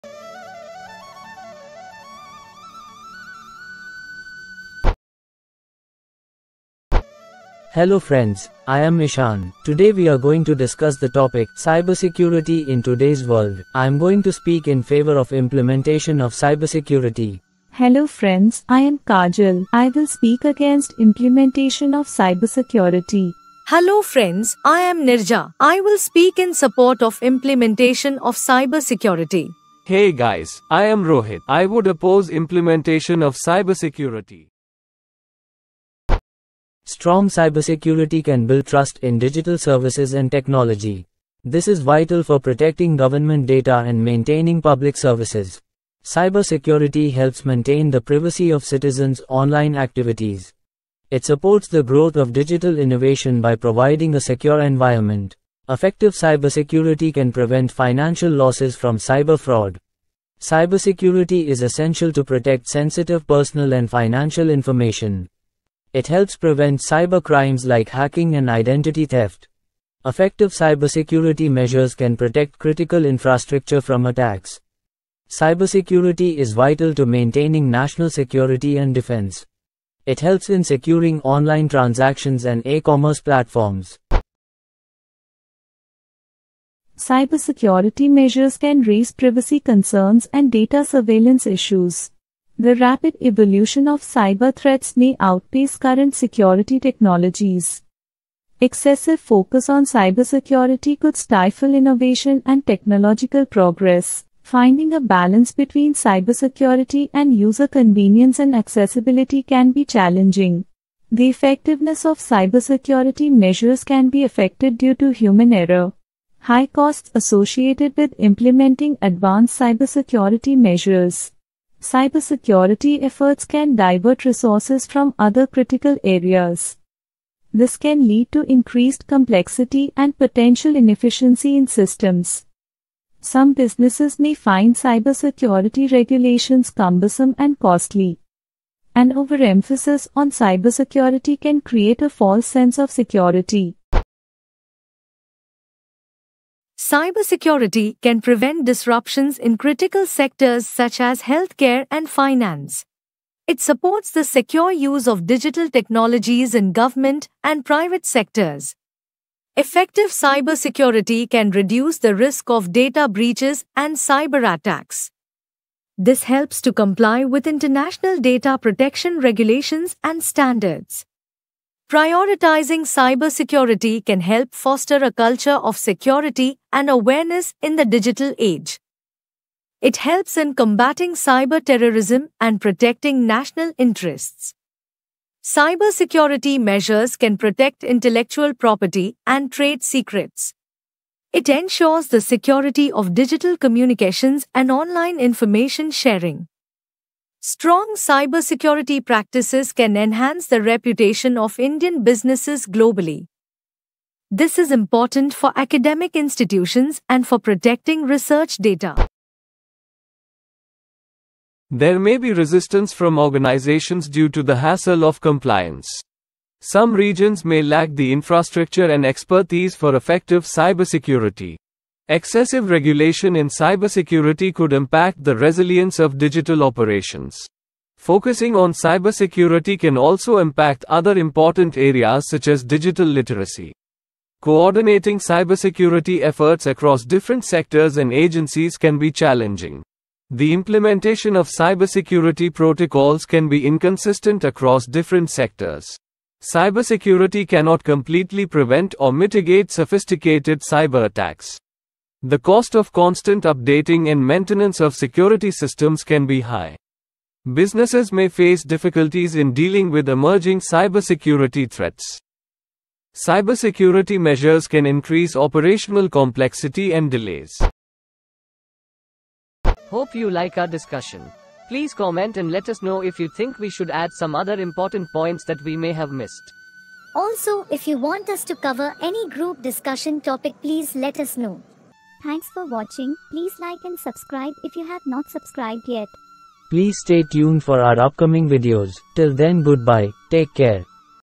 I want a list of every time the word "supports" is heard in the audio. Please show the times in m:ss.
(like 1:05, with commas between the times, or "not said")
0:26, 0:51, 2:33.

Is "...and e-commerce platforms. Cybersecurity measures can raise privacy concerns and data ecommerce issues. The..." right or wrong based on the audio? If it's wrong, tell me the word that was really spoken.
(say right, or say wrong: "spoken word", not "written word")
wrong: "surveillance", not "ecommerce".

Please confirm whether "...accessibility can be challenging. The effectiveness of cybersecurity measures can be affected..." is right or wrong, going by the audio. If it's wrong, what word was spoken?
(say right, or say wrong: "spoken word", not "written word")
right.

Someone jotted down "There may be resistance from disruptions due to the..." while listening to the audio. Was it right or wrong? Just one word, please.
wrong.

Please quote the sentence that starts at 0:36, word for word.
Strong cybersecurity can build trust in digital services and technology.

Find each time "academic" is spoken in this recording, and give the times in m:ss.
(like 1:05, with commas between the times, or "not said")
3:25.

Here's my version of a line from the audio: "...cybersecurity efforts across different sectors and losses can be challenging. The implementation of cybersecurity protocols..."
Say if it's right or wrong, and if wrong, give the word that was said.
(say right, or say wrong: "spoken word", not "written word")
wrong: "agencies", not "losses".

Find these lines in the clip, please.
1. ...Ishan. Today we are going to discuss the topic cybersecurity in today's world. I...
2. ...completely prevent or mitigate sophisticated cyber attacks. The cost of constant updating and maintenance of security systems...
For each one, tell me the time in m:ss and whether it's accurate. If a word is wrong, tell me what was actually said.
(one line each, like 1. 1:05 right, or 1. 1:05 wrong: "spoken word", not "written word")
1. 0:08 right
2. 4:07 right.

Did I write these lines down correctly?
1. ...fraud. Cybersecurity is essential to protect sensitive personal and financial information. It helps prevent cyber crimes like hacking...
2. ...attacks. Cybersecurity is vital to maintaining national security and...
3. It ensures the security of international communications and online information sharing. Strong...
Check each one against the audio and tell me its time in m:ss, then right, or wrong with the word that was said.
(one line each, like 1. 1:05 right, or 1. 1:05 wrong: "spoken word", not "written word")
1. 0:59 right
2. 1:14 right
3. 3:11 wrong: "digital", not "international".